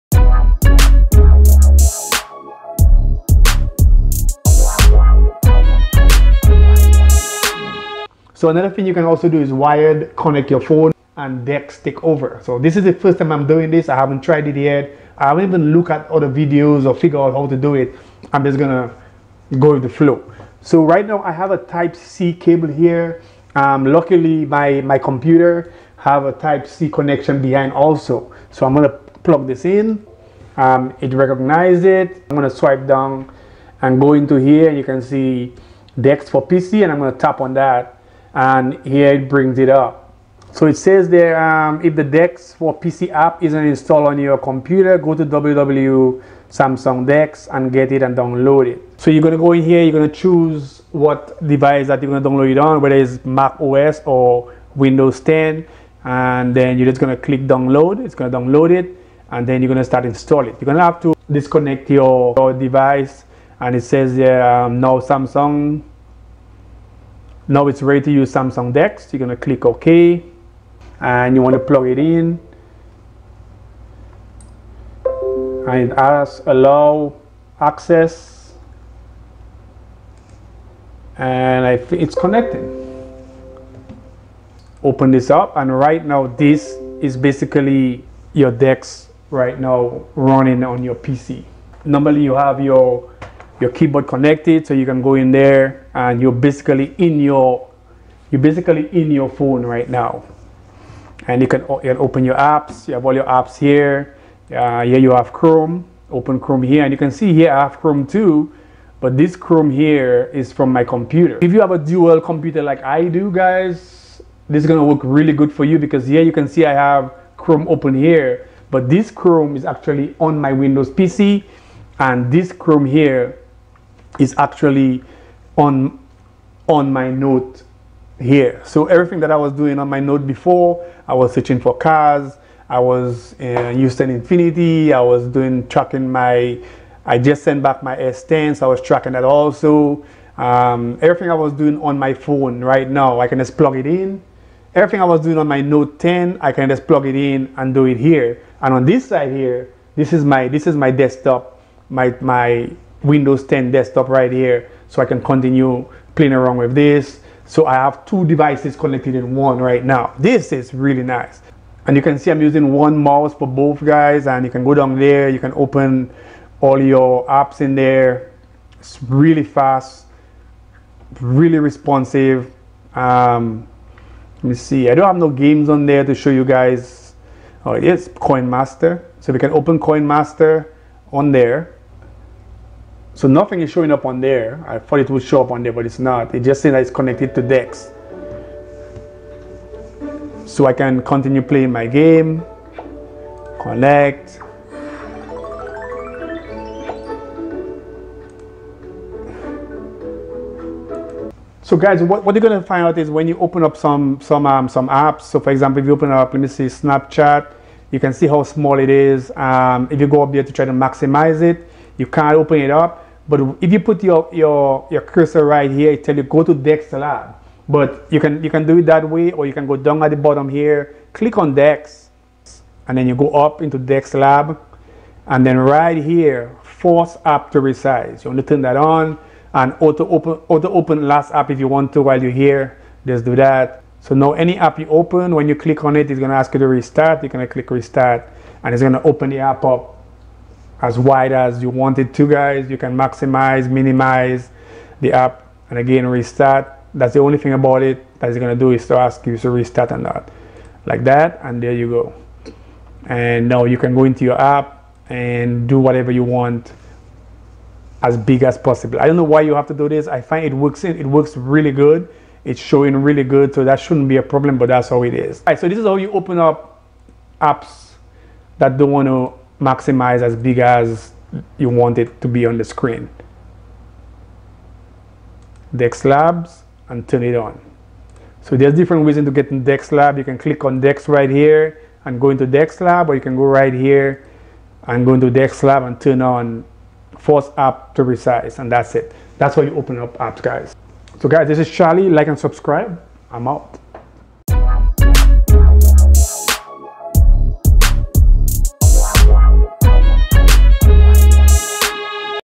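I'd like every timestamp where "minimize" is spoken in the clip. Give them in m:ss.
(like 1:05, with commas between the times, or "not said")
4:03.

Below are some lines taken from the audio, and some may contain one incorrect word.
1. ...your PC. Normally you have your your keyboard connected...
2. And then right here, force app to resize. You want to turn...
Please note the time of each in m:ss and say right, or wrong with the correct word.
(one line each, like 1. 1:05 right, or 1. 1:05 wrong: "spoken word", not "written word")
1. 1:30 right
2. 3:45 right.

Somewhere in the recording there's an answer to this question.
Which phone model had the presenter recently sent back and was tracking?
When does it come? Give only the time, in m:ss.
2:17.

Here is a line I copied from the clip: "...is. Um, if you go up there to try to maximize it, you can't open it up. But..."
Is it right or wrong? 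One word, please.
right.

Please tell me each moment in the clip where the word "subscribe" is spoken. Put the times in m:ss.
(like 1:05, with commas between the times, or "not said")
4:52.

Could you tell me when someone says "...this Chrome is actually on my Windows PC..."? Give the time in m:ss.
1:58.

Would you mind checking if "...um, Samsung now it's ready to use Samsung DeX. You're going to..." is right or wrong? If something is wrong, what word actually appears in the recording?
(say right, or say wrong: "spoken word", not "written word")
right.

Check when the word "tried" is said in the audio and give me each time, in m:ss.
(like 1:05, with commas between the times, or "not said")
0:14.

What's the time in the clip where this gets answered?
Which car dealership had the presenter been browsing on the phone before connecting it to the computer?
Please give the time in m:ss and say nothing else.
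2:13.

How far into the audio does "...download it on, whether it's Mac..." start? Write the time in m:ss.
0:52.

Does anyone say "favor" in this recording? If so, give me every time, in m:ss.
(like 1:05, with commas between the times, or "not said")
not said.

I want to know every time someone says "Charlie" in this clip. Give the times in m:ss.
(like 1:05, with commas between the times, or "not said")
4:51.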